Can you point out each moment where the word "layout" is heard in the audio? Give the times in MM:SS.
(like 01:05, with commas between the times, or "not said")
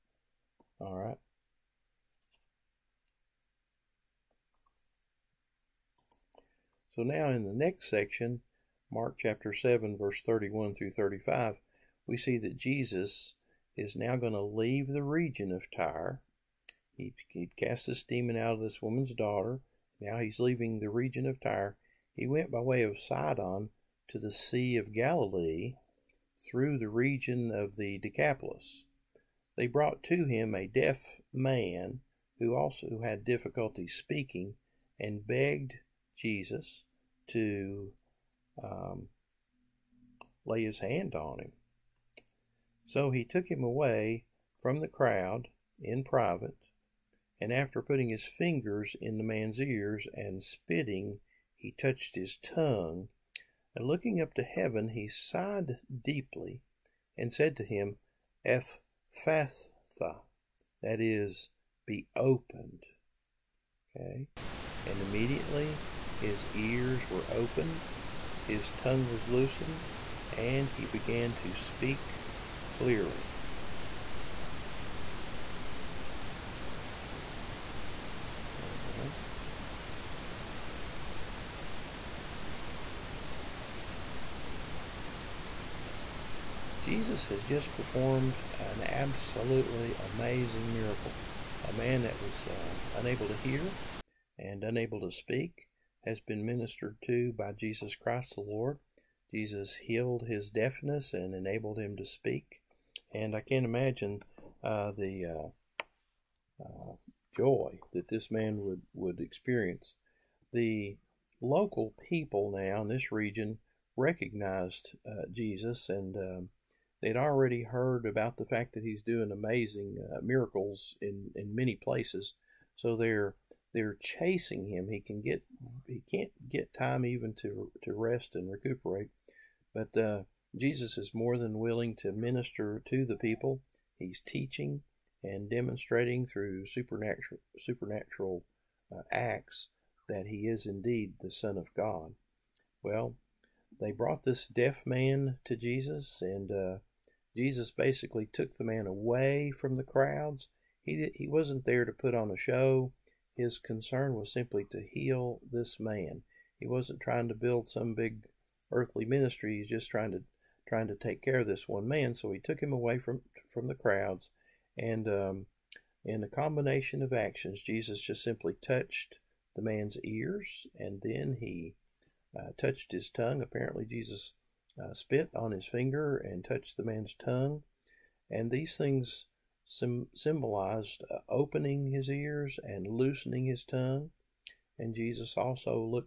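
not said.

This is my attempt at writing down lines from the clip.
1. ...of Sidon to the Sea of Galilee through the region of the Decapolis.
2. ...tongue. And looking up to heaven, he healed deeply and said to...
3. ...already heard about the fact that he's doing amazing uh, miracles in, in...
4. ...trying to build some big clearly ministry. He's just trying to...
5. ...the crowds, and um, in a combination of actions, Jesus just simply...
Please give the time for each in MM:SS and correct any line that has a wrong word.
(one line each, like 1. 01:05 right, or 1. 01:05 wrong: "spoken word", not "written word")
1. 00:22 right
2. 00:52 wrong: "sighed", not "healed"
3. 01:57 right
4. 02:36 wrong: "earthly", not "clearly"
5. 02:43 right.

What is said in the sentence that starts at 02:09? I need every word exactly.
But uh, Jesus is more than willing to minister to the people.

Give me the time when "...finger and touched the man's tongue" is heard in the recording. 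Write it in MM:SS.
02:55.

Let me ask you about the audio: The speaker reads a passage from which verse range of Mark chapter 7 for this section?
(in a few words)
31 through 35.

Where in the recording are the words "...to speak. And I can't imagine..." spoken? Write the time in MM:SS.
01:41.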